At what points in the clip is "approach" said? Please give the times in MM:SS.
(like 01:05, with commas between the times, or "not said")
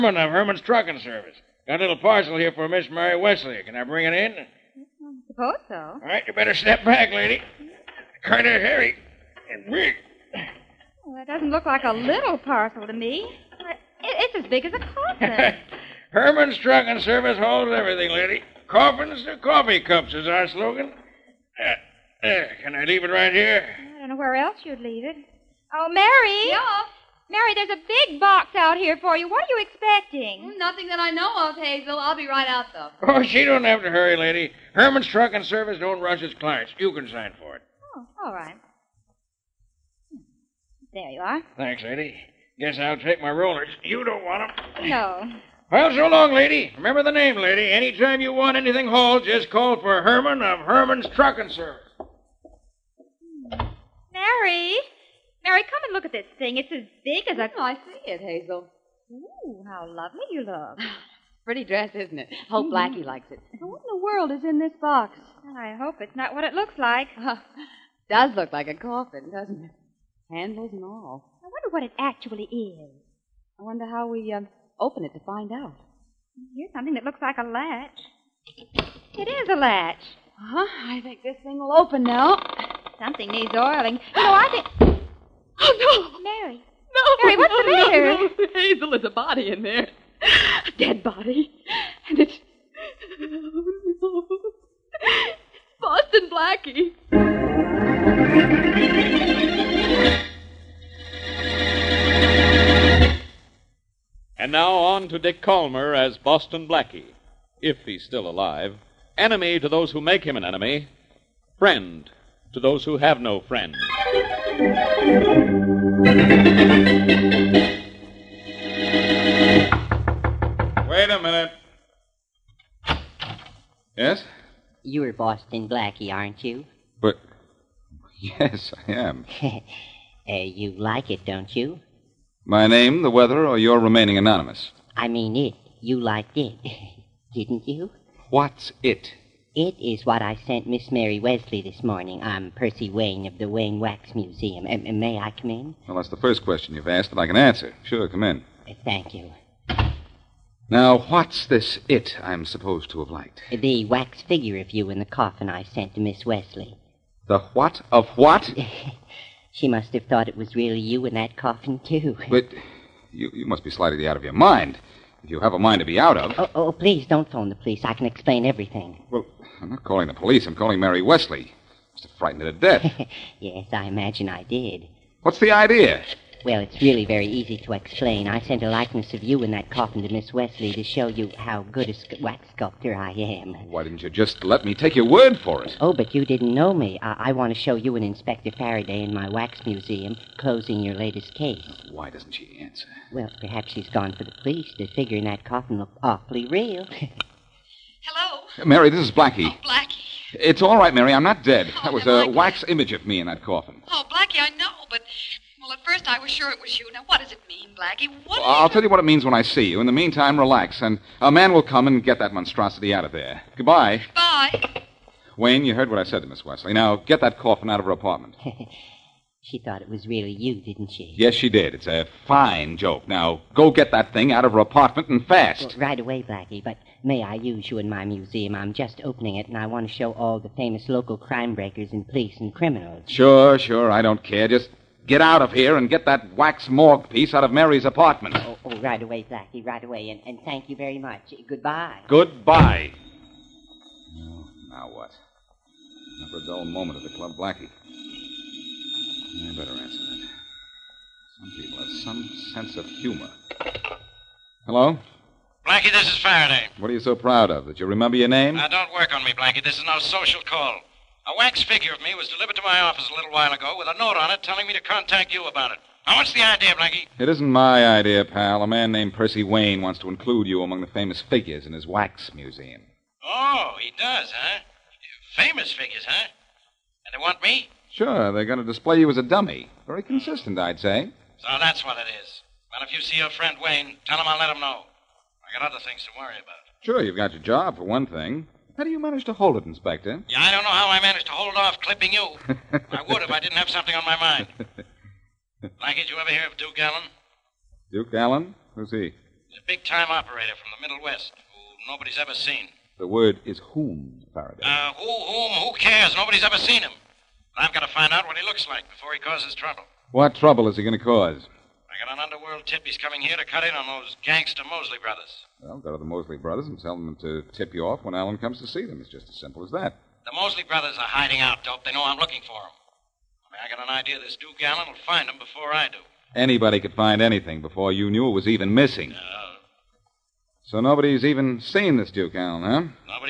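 not said.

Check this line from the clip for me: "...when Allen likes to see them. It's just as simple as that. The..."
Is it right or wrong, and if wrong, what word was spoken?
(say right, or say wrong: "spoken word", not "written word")
wrong: "comes", not "likes".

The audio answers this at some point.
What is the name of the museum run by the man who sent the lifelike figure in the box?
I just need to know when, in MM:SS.
02:23.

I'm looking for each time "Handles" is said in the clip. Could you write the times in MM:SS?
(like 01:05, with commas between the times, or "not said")
01:10.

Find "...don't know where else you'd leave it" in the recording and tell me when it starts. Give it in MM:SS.
00:24.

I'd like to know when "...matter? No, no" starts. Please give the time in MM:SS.
01:27.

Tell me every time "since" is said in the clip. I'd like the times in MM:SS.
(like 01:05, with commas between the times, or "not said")
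not said.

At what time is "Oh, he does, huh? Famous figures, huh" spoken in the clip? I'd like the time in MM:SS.
04:33.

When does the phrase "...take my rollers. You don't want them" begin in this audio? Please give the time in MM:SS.
00:42.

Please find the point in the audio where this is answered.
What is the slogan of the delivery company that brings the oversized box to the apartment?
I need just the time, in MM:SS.
00:18.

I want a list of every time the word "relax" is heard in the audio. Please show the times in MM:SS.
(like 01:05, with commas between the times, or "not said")
03:30.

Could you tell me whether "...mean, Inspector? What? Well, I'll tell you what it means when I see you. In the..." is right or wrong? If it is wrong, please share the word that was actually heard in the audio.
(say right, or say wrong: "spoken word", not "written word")
wrong: "Blackie", not "Inspector".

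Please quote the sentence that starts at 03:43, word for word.
Now, go get that thing out of her apartment and fast.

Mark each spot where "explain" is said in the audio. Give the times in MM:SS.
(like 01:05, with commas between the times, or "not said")
02:48, 02:57.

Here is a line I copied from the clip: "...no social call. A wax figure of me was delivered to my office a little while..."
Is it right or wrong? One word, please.
right.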